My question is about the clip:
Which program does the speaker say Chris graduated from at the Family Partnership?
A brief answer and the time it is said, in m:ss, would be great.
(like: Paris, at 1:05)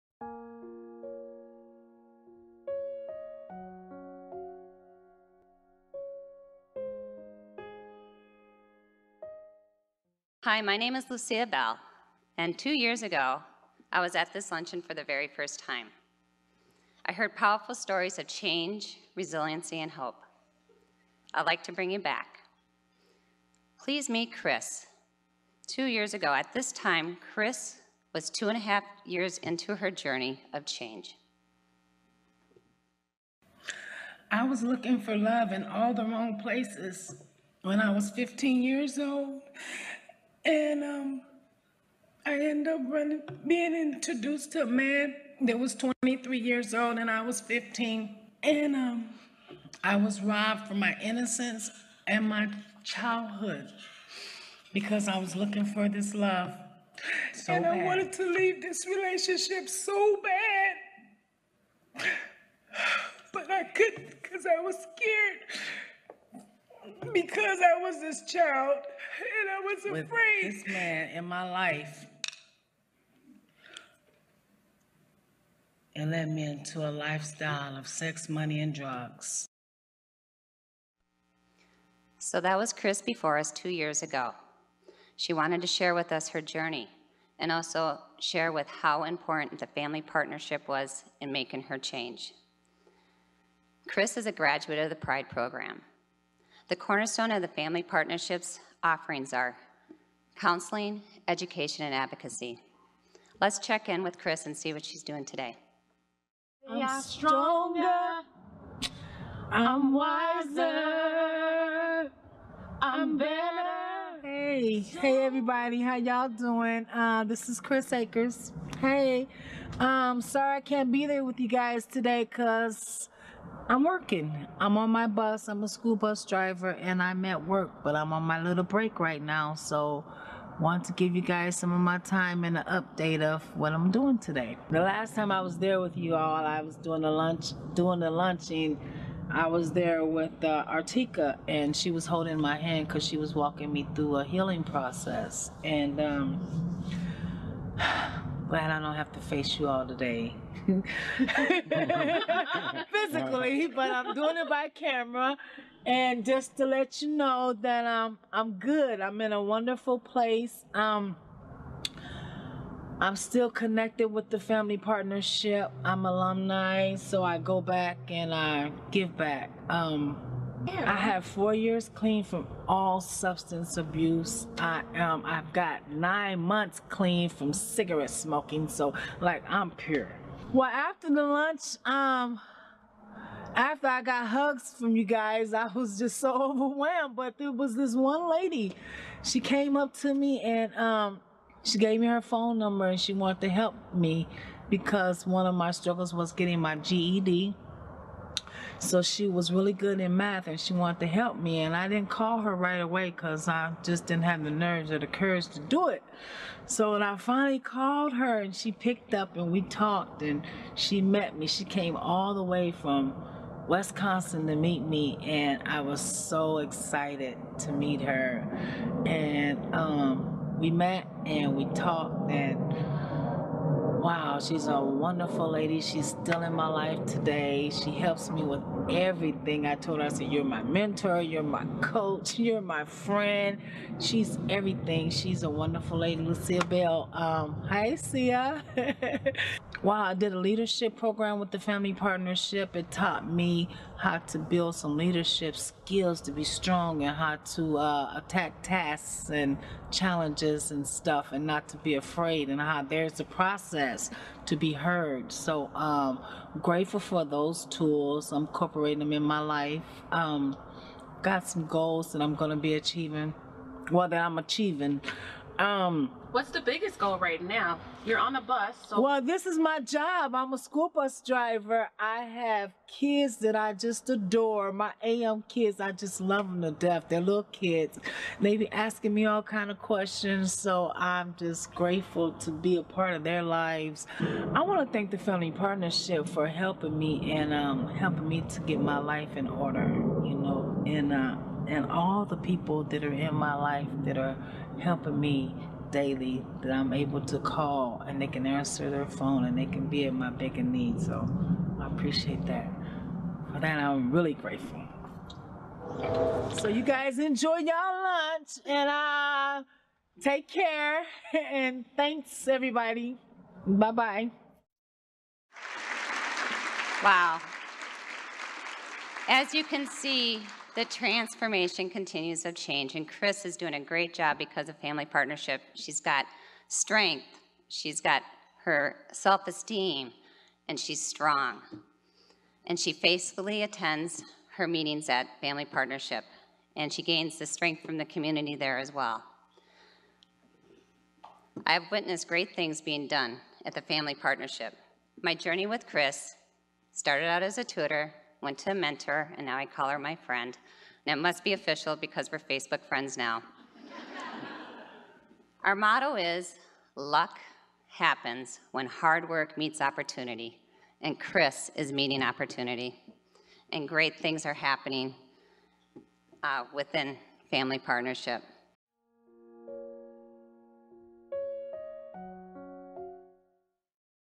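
Pride program, at 1:34.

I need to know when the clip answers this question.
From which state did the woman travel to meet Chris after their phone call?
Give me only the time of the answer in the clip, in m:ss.
3:33.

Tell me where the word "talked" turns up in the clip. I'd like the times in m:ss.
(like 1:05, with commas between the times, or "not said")
3:29, 3:41.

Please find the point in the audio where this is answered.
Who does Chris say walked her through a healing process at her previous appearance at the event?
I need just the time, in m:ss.
2:20.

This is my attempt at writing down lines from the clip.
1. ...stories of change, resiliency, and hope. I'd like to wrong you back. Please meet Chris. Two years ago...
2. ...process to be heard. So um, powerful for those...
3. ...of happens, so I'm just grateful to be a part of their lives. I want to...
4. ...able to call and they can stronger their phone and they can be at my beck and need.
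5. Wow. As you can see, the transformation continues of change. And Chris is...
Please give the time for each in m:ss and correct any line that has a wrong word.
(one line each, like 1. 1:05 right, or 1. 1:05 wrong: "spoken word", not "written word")
1. 0:17 wrong: "bring", not "wrong"
2. 4:13 wrong: "grateful", not "powerful"
3. 4:39 wrong: "questions", not "happens"
4. 4:56 wrong: "answer", not "stronger"
5. 5:17 right.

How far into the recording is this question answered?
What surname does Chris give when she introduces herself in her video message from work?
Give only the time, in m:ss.
1:57.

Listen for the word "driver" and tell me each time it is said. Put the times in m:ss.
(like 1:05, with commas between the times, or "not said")
2:06, 4:31.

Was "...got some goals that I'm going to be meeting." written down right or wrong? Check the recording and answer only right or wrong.
wrong.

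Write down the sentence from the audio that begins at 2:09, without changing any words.
So, want to give you guys some of my time and an update of what I'm doing today.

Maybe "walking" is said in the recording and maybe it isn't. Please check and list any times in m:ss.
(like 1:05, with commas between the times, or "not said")
2:23.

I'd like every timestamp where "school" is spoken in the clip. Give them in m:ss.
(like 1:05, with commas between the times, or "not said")
2:05, 4:30.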